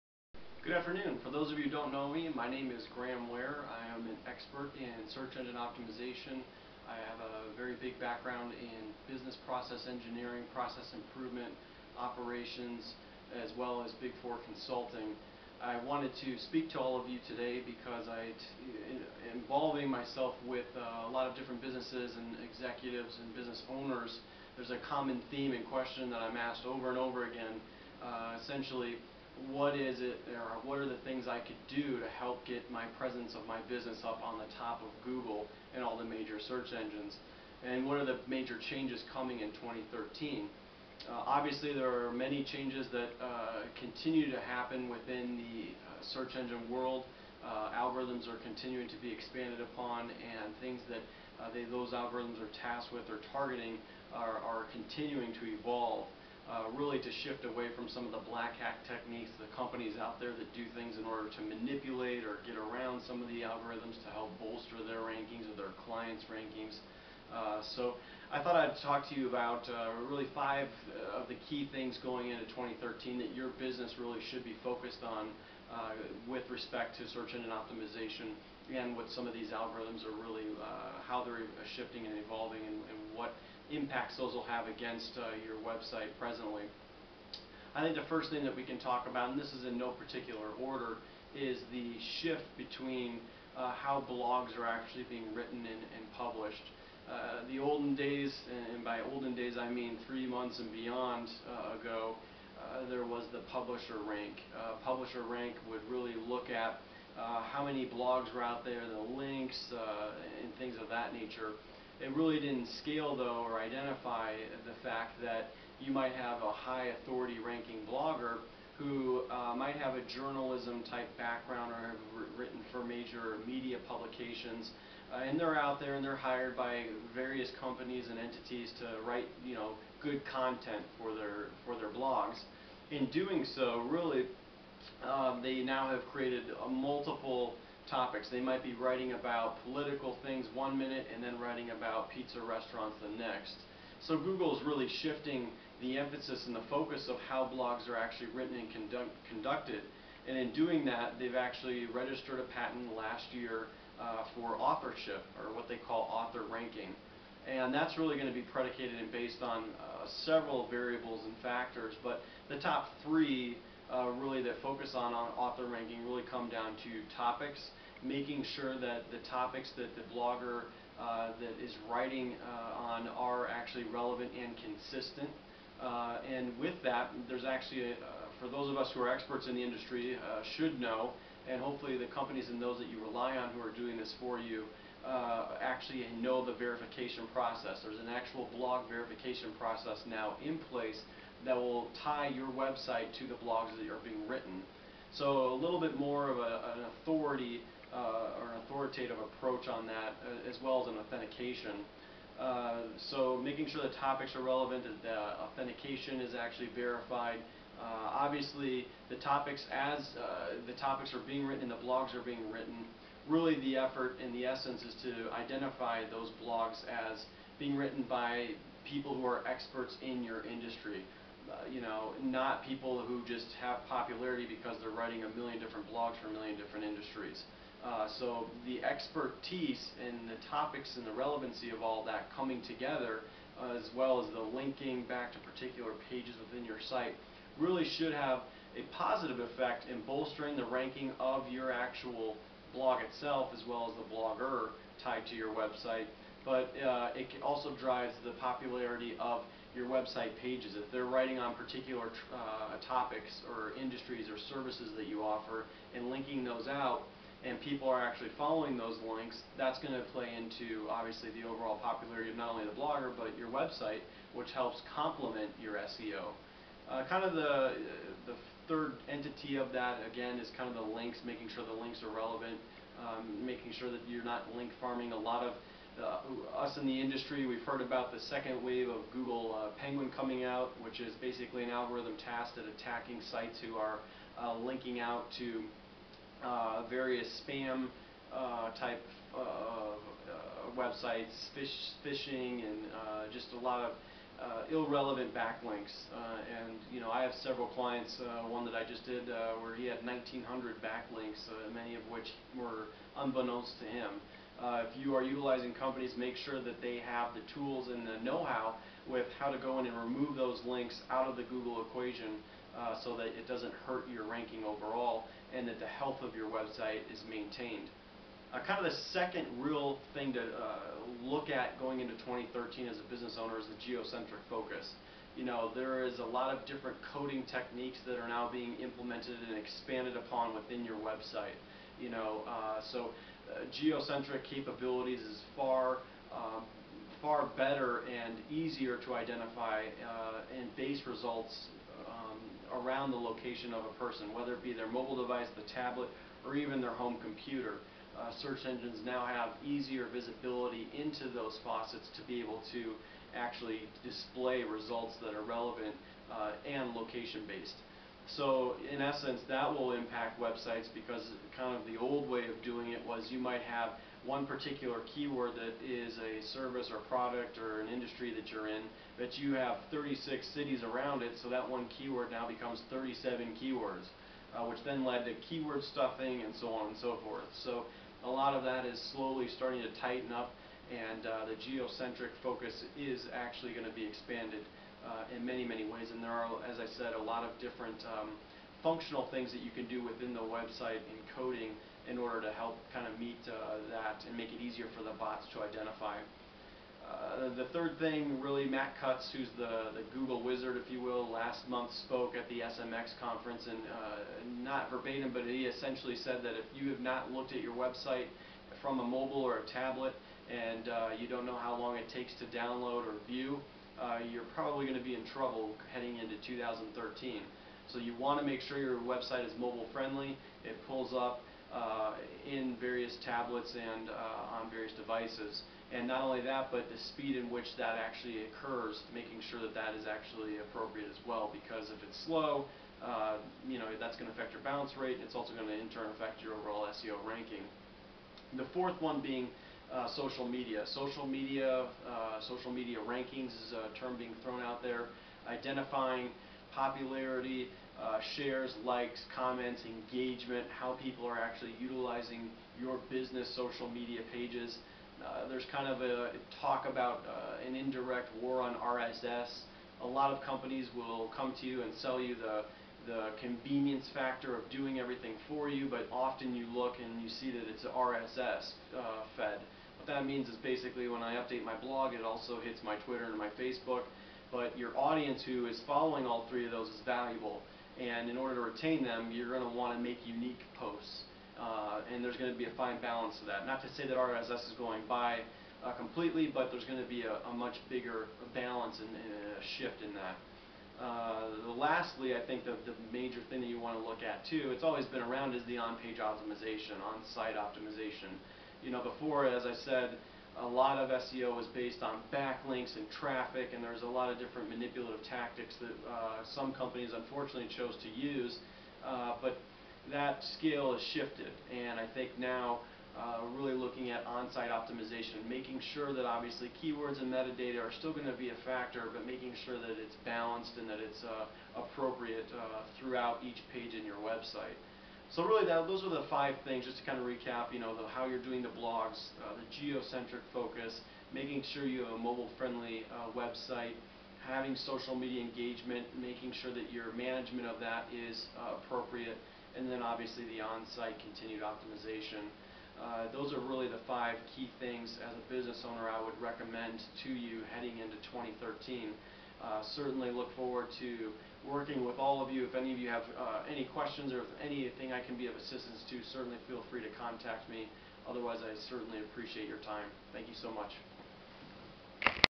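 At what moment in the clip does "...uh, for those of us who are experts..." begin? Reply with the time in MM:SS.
02:57.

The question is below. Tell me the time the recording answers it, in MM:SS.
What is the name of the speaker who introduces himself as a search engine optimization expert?
00:02.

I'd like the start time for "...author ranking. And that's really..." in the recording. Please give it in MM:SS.
02:36.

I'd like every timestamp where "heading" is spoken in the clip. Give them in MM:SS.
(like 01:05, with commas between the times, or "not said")
06:55, 09:07.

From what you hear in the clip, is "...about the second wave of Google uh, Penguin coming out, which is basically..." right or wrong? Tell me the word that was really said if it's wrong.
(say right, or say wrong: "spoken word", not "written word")
right.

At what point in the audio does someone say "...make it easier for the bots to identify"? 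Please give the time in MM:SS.
06:34.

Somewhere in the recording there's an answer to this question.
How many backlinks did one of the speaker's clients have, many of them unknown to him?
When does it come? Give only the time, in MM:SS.
05:00.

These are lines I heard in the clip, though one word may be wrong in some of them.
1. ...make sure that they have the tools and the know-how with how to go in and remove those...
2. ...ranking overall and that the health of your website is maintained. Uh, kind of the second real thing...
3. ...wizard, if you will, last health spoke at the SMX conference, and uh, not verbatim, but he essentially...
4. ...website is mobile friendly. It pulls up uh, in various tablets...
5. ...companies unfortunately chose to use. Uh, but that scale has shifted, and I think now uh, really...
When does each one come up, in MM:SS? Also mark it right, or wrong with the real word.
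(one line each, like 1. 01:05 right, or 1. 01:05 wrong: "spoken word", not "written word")
1. 05:06 right
2. 05:14 right
3. 06:40 wrong: "month", not "health"
4. 06:58 right
5. 08:26 right.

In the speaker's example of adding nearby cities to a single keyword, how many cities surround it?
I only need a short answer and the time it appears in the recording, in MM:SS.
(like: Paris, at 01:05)
36, at 06:09.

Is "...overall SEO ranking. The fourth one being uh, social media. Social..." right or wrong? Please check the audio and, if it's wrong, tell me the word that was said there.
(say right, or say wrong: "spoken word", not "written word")
right.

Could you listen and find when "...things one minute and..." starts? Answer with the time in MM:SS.
02:20.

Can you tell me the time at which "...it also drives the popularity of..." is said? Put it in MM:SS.
04:07.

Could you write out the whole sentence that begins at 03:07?
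There's an actual blog verification process now in place that will tie your website to the blogs that are being written.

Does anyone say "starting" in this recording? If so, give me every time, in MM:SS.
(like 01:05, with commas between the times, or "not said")
06:19.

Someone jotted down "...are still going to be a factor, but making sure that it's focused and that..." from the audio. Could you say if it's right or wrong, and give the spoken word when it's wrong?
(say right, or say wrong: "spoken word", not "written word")
wrong: "balanced", not "focused".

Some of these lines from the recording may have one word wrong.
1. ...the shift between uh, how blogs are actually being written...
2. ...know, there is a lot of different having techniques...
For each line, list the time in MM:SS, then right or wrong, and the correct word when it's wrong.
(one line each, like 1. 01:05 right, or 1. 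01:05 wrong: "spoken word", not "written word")
1. 01:31 right
2. 05:25 wrong: "coding", not "having".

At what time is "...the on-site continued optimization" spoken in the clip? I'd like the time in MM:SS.
09:00.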